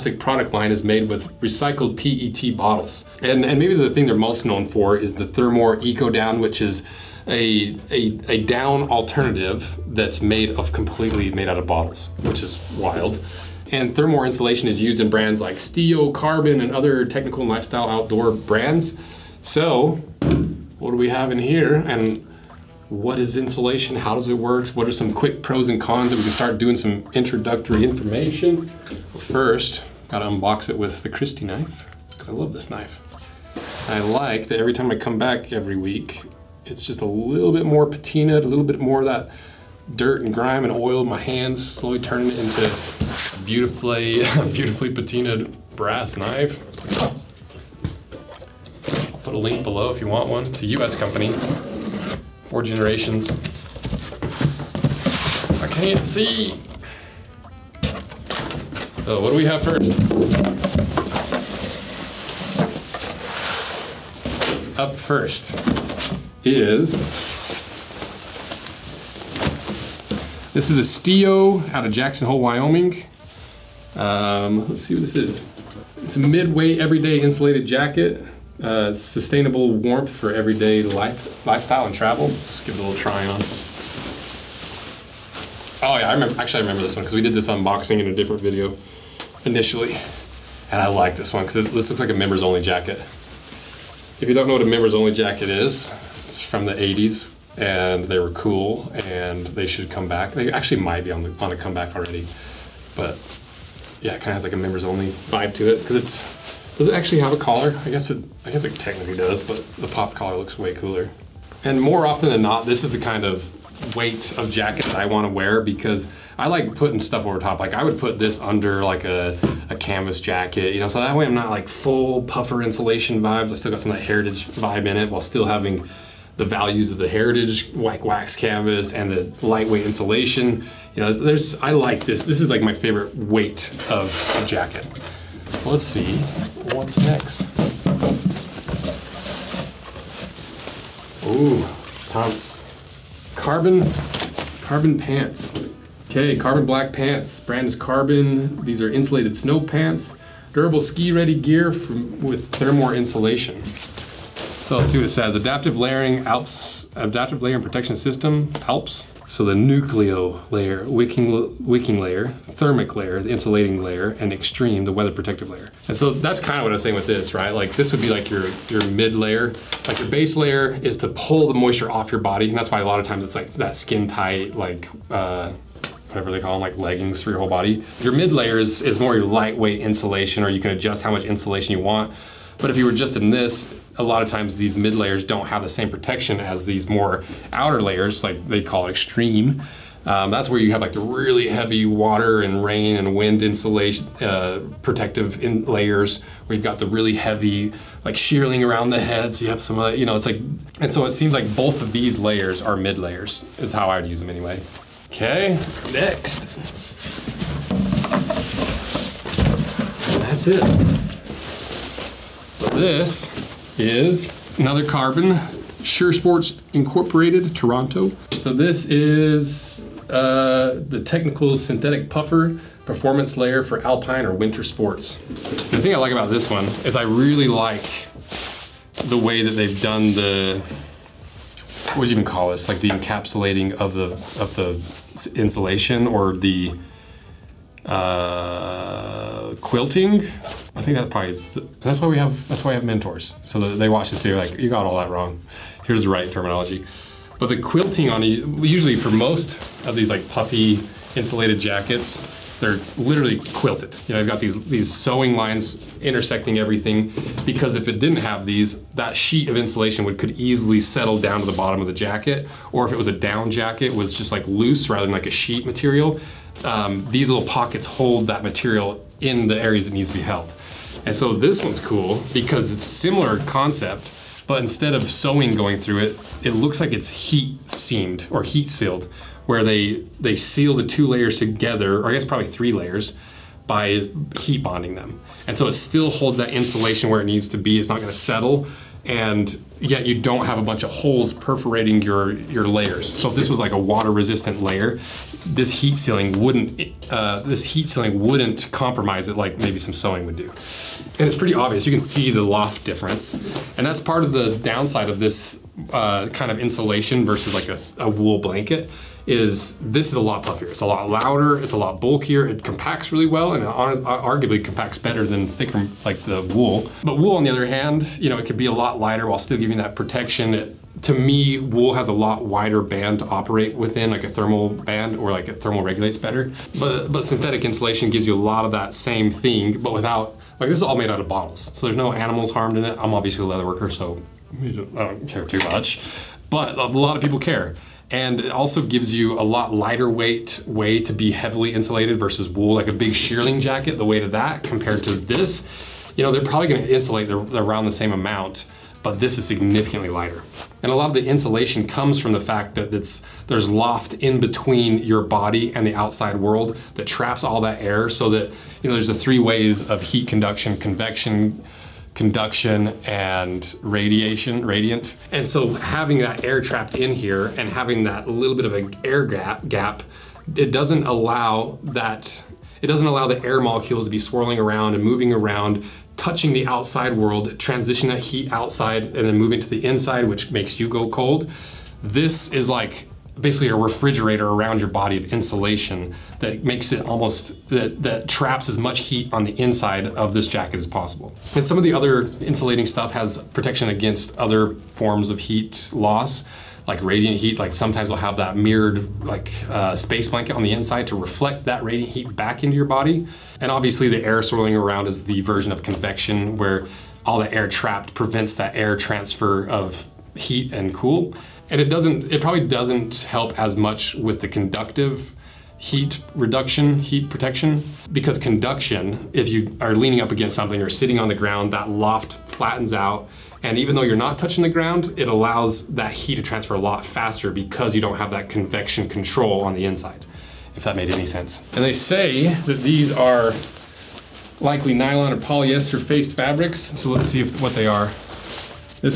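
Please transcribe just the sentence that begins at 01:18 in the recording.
Uh, sustainable warmth for everyday life, lifestyle and travel.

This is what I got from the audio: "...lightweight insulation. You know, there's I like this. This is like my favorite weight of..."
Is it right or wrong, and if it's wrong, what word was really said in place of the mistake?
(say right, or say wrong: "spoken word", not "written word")
right.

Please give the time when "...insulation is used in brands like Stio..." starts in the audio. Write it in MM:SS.
00:14.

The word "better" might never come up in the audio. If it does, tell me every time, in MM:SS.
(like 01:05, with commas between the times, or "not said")
05:14, 05:26.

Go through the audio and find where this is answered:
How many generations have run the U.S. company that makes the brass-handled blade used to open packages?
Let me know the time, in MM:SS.
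00:52.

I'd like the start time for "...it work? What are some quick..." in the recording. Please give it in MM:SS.
00:24.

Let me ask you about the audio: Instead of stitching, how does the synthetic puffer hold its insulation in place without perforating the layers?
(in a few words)
heat sealed.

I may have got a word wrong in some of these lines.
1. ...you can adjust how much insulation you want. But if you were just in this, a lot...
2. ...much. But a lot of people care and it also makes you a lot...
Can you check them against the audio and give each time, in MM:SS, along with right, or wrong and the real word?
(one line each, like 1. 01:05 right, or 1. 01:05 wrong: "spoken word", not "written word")
1. 03:00 right
2. 05:35 wrong: "gives", not "makes".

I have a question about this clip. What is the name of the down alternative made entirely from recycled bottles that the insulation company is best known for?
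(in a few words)
Thermore Eco Down.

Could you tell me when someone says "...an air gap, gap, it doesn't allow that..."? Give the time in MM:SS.
06:08.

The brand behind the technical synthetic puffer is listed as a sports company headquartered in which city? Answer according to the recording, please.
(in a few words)
Toronto.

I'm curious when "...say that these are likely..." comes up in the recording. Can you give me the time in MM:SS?
07:11.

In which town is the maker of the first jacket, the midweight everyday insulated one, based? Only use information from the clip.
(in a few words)
Jackson Hole, Wyoming.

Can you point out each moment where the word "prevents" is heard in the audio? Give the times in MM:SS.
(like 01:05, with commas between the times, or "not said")
06:48.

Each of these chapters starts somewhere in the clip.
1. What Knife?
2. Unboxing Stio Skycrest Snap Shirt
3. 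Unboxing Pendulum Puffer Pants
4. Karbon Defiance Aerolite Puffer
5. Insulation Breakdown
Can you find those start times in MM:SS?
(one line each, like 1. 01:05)
1. 00:28
2. 00:57
3. 02:17
4. 03:26
5. 04:08.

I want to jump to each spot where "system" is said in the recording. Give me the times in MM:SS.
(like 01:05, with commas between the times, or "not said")
02:37.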